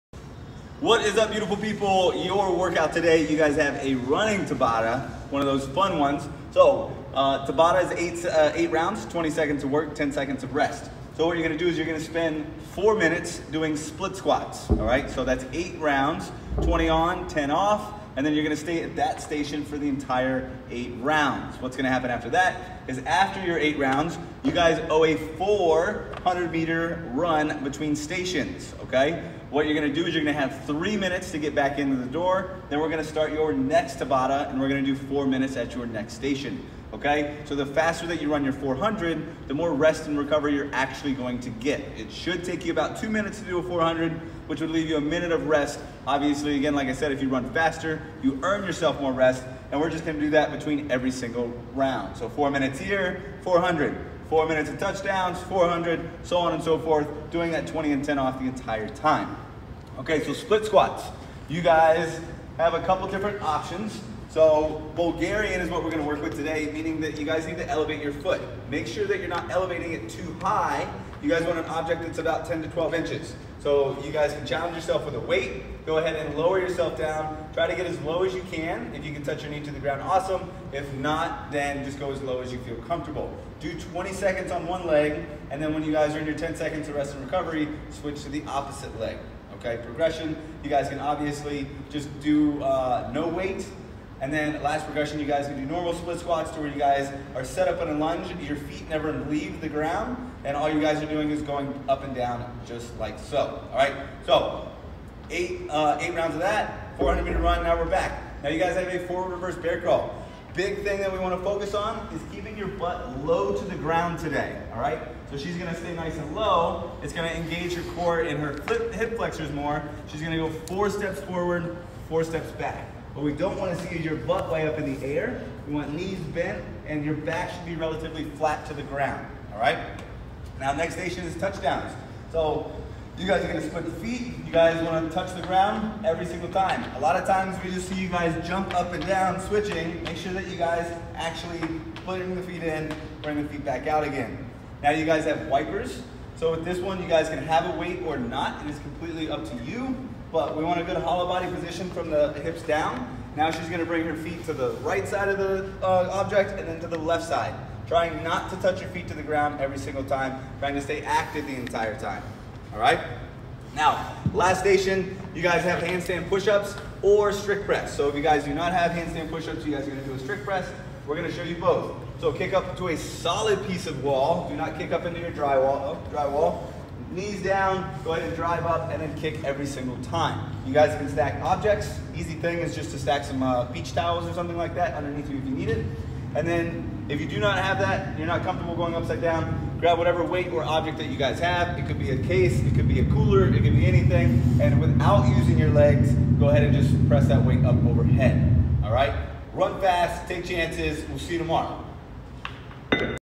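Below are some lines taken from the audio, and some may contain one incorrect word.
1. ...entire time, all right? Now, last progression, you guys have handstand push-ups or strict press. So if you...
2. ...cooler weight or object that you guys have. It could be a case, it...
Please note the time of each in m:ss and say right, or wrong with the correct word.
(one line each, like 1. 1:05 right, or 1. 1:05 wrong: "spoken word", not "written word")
1. 2:41 wrong: "station", not "progression"
2. 3:09 wrong: "whatever", not "cooler".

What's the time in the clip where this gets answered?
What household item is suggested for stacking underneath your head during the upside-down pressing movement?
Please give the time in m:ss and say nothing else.
3:03.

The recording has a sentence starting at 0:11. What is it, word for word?
So what you're gonna do is you're gonna spend four minutes doing split squats, all right?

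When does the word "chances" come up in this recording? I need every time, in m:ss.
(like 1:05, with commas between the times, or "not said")
3:20.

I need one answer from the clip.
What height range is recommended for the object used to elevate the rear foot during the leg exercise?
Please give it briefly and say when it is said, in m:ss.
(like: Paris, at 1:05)
10 to 12 inches, at 1:12.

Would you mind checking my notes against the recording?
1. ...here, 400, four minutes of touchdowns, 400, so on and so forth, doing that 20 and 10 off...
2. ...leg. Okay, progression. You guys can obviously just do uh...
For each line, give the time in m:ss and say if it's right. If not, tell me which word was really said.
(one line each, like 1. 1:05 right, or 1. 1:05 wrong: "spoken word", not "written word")
1. 0:52 right
2. 1:28 right.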